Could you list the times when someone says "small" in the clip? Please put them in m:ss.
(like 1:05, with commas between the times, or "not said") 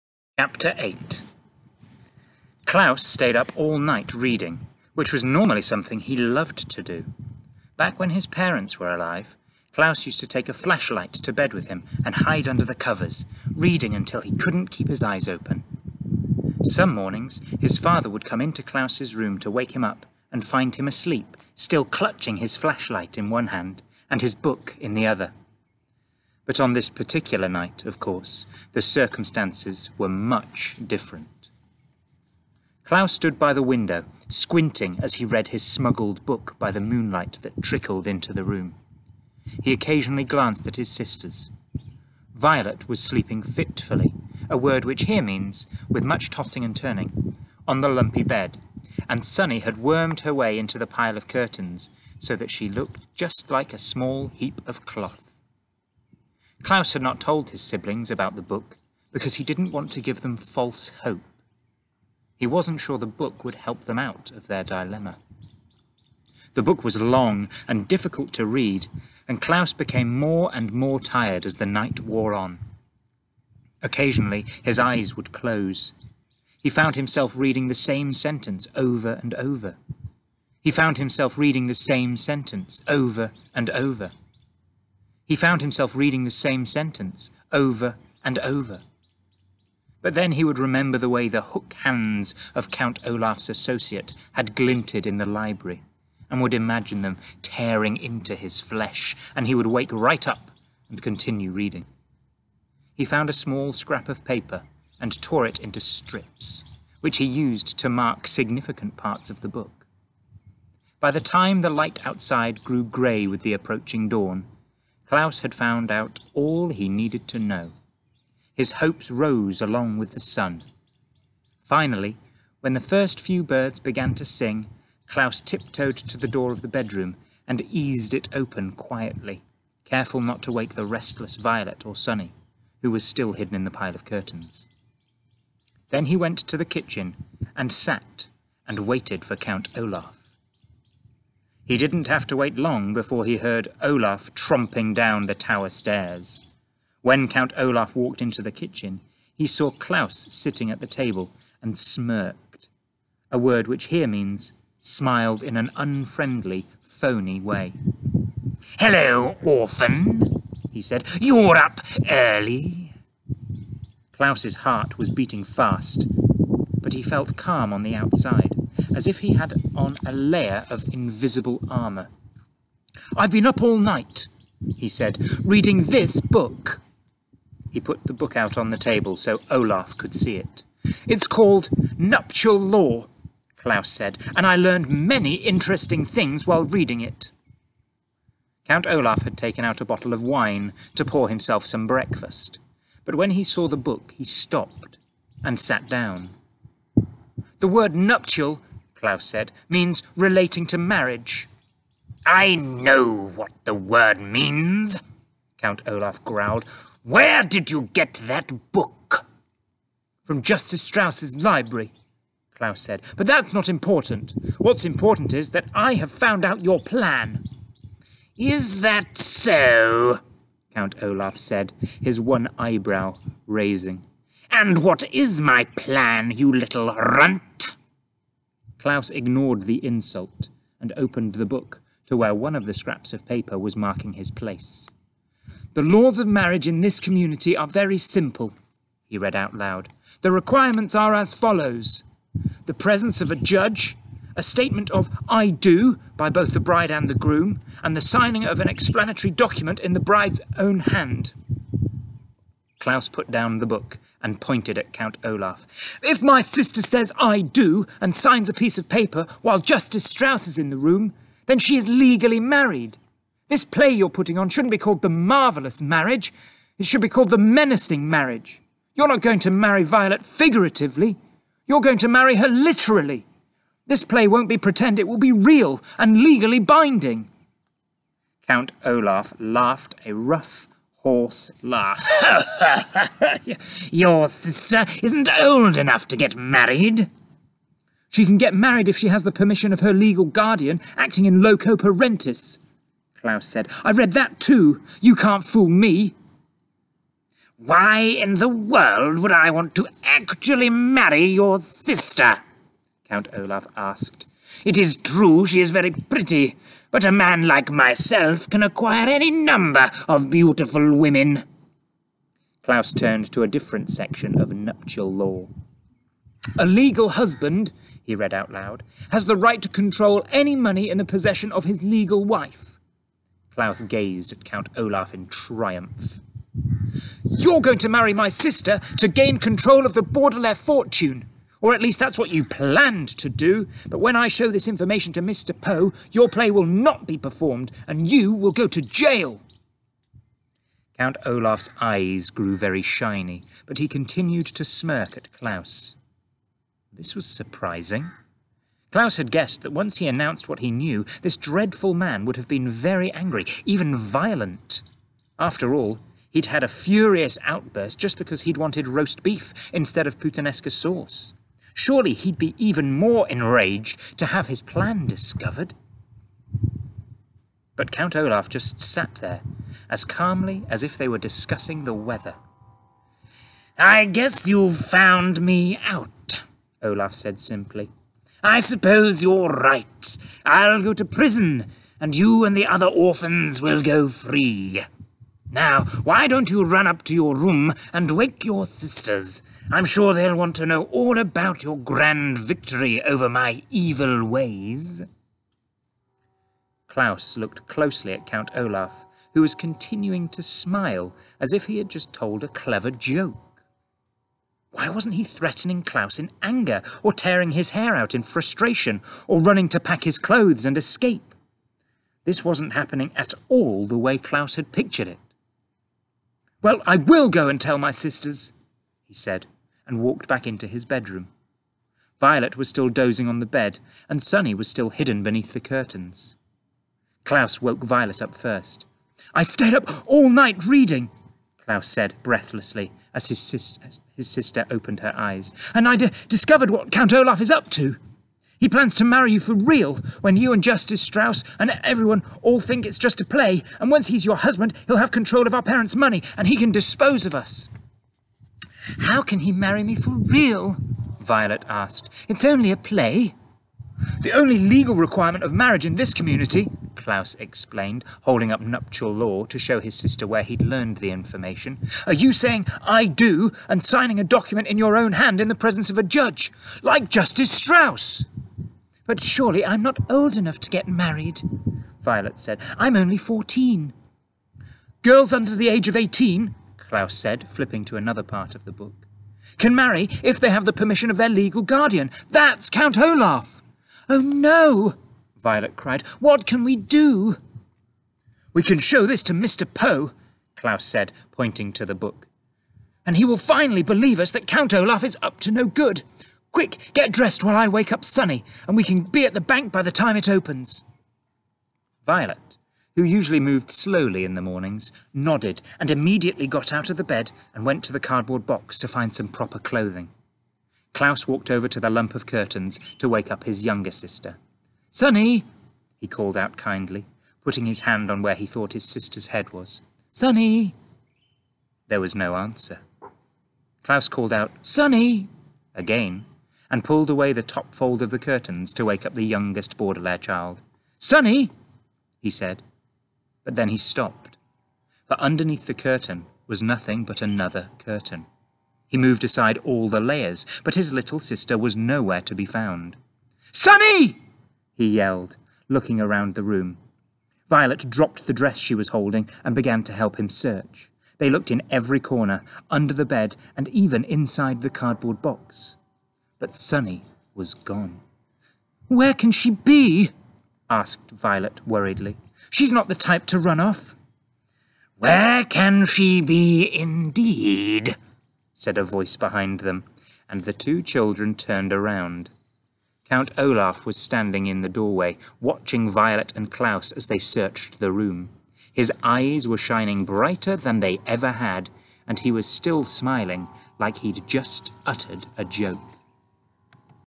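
0:53, 1:43.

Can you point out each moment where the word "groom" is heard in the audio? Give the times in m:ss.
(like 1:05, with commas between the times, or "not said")
4:07.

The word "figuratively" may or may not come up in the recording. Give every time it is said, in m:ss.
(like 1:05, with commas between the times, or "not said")
4:30.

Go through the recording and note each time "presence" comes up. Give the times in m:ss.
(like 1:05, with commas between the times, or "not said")
4:02, 7:45.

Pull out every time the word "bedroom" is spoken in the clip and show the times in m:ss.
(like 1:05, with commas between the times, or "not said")
2:06, 7:00.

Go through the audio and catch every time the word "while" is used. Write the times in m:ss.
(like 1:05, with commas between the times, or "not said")
3:06, 4:19, 8:17.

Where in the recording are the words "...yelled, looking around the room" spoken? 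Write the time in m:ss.
9:04.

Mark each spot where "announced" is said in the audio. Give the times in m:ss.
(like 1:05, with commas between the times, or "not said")
5:50.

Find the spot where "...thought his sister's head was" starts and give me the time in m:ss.
8:38.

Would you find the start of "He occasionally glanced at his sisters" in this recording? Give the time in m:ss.
0:39.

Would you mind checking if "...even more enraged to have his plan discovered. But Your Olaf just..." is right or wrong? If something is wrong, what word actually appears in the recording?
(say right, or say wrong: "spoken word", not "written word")
wrong: "Count", not "Your".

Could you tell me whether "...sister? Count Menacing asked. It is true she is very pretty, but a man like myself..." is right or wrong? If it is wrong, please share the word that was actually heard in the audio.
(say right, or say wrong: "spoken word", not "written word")
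wrong: "Olaf", not "Menacing".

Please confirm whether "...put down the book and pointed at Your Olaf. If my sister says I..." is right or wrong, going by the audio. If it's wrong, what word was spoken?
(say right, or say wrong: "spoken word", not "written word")
wrong: "Count", not "Your".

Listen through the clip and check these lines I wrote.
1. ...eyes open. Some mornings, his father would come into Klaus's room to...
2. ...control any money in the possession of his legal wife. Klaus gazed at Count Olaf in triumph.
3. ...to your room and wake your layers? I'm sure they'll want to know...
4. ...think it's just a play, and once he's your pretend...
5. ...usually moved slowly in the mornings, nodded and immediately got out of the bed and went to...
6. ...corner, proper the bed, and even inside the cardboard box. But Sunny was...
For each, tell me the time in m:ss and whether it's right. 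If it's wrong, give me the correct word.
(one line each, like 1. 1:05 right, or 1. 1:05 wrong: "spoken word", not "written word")
1. 0:15 right
2. 5:19 right
3. 6:27 wrong: "sisters", not "layers"
4. 7:22 wrong: "husband", not "pretend"
5. 8:23 right
6. 9:11 wrong: "under", not "proper".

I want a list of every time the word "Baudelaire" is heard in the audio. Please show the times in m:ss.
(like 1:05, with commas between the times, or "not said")
5:30, 8:49.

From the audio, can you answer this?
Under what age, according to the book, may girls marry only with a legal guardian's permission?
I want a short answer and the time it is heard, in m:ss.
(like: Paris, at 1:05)
18, at 7:55.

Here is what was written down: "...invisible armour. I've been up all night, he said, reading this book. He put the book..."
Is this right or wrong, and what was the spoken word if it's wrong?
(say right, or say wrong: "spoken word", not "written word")
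right.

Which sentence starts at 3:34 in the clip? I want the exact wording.
What's important is that I have found out your plan.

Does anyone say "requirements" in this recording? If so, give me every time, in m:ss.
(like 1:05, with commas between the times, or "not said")
4:00, 7:34.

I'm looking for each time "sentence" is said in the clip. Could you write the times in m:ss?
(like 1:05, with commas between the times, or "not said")
1:18, 1:22, 1:26.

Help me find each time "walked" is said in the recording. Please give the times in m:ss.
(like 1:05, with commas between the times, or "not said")
2:27, 6:59, 8:31.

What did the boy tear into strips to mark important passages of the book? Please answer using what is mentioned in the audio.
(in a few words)
scrap of paper.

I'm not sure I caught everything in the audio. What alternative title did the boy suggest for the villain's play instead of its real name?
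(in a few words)
The Menacing Marriage.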